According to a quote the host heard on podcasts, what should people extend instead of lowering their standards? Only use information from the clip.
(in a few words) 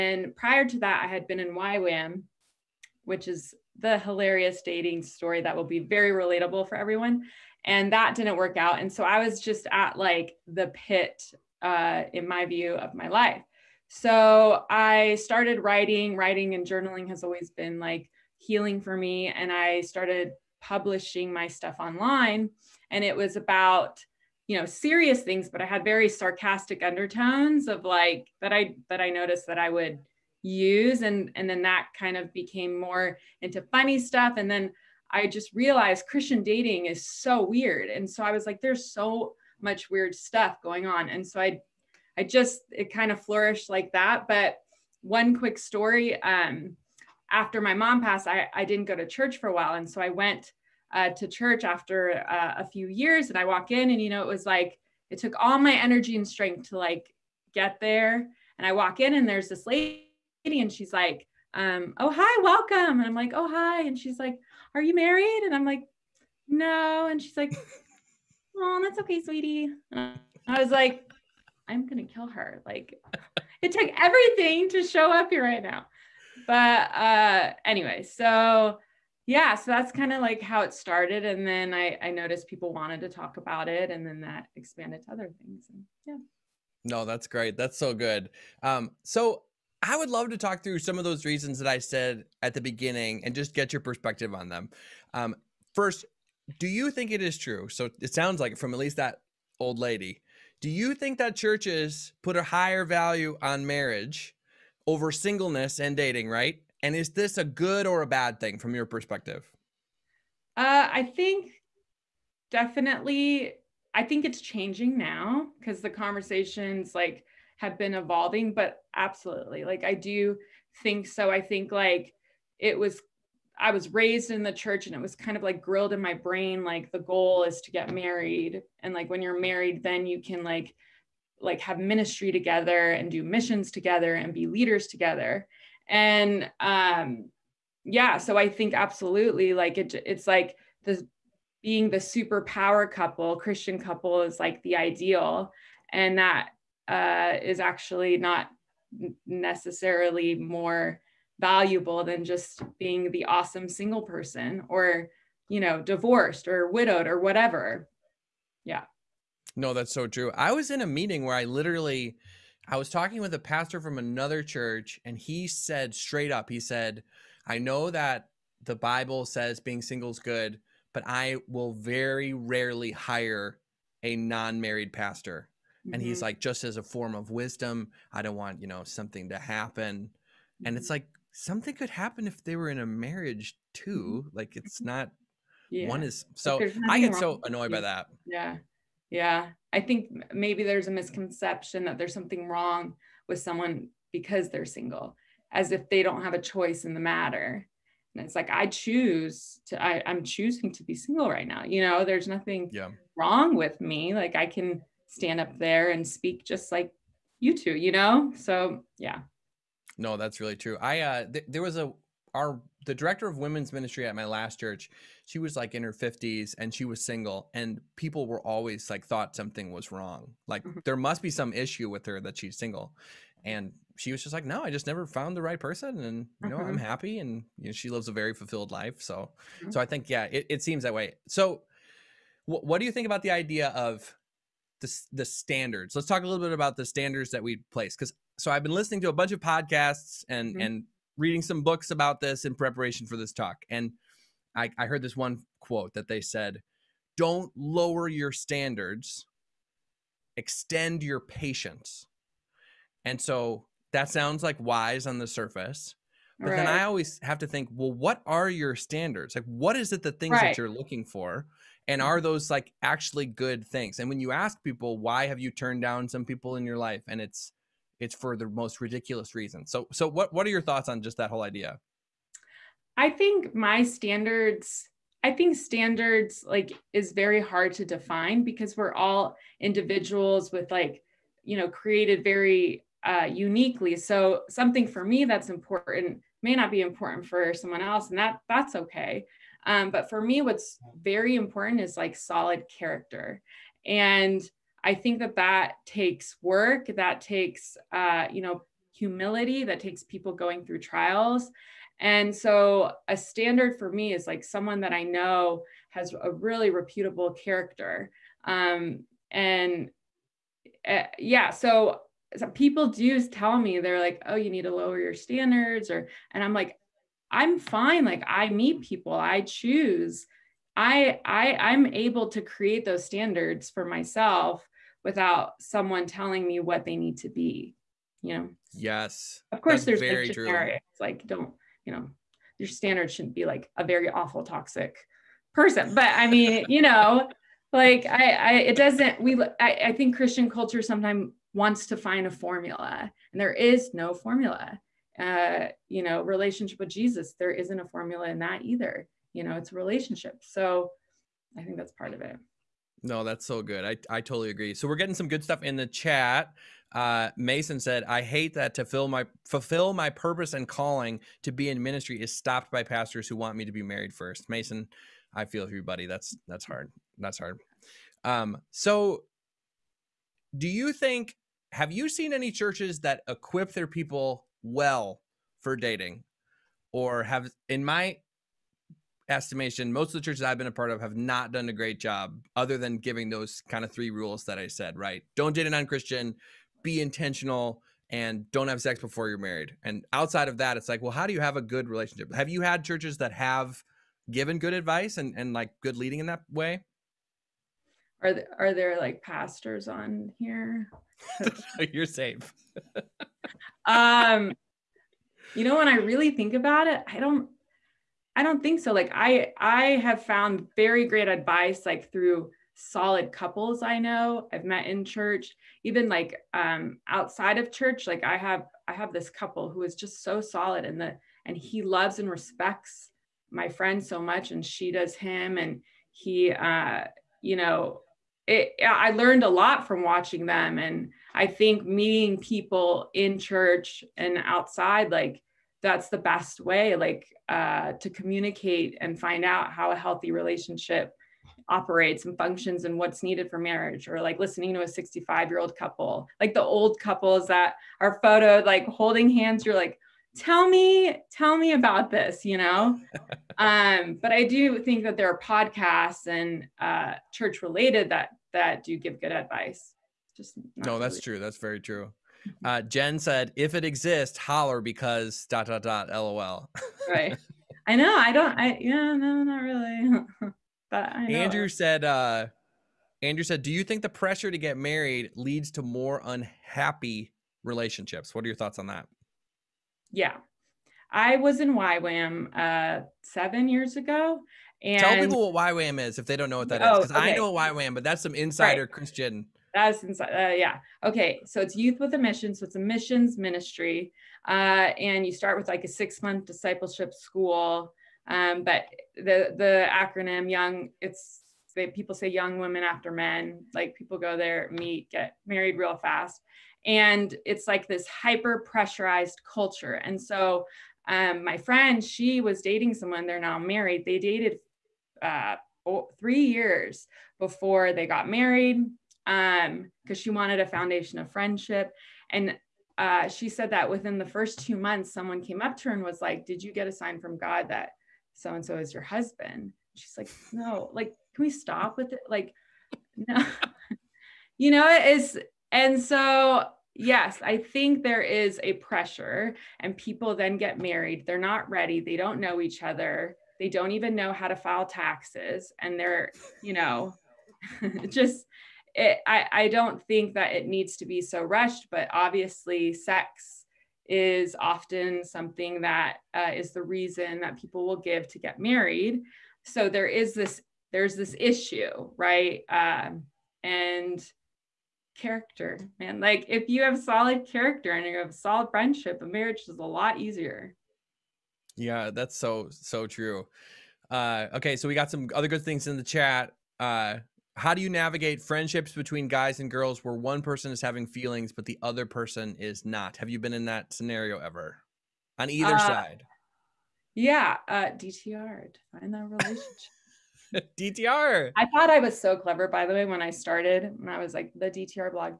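patience.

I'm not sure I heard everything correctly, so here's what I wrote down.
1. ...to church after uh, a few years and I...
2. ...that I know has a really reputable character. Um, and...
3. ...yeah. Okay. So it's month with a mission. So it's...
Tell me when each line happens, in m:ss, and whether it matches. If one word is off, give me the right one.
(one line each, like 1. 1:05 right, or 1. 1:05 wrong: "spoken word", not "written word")
1. 0:51 right
2. 5:04 right
3. 8:10 wrong: "youth", not "month".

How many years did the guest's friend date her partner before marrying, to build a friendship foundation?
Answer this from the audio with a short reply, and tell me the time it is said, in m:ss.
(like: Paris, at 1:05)
3, at 8:36.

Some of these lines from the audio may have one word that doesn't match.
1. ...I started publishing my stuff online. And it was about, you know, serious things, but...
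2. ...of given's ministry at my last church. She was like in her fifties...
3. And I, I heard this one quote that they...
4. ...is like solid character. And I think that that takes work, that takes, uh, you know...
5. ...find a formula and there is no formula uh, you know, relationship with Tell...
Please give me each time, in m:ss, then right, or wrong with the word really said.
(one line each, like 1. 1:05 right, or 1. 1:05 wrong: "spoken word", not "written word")
1. 0:19 right
2. 3:33 wrong: "women", not "given"
3. 4:03 right
4. 4:51 right
5. 5:41 wrong: "Jesus", not "Tell".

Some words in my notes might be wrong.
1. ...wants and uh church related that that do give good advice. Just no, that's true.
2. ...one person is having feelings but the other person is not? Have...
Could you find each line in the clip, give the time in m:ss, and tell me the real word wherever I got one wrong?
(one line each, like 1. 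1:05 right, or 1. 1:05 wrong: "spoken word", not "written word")
1. 7:35 wrong: "podcasts", not "wants"
2. 9:40 right.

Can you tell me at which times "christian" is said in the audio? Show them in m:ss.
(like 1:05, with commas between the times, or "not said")
0:36, 2:23, 5:40, 6:25, 8:08.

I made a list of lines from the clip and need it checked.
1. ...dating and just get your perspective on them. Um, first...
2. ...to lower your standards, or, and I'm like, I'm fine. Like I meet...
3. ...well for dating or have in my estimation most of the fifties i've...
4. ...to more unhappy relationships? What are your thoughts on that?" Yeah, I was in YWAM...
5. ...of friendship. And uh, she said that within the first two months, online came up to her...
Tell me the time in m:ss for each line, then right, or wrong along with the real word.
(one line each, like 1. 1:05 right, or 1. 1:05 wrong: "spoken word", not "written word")
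1. 1:32 wrong: "beginning", not "dating"
2. 5:14 right
3. 6:14 wrong: "churches", not "fifties"
4. 7:55 right
5. 8:41 wrong: "someone", not "online".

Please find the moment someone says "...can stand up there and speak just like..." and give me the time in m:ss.
3:24.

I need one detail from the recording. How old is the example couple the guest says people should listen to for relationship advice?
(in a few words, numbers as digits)
65.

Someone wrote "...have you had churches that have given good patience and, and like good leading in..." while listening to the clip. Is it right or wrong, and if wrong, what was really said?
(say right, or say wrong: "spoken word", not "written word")
wrong: "advice", not "patience".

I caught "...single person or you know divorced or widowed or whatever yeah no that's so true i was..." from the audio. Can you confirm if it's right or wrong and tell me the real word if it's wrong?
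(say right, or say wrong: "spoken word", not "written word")
right.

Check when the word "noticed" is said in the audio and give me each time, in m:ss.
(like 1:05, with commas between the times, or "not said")
0:29, 1:22.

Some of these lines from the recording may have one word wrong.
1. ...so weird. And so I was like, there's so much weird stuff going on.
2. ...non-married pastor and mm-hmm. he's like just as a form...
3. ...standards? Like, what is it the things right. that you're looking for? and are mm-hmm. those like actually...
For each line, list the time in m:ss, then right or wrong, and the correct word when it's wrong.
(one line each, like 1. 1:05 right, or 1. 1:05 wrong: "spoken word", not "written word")
1. 0:37 right
2. 2:54 right
3. 4:18 right.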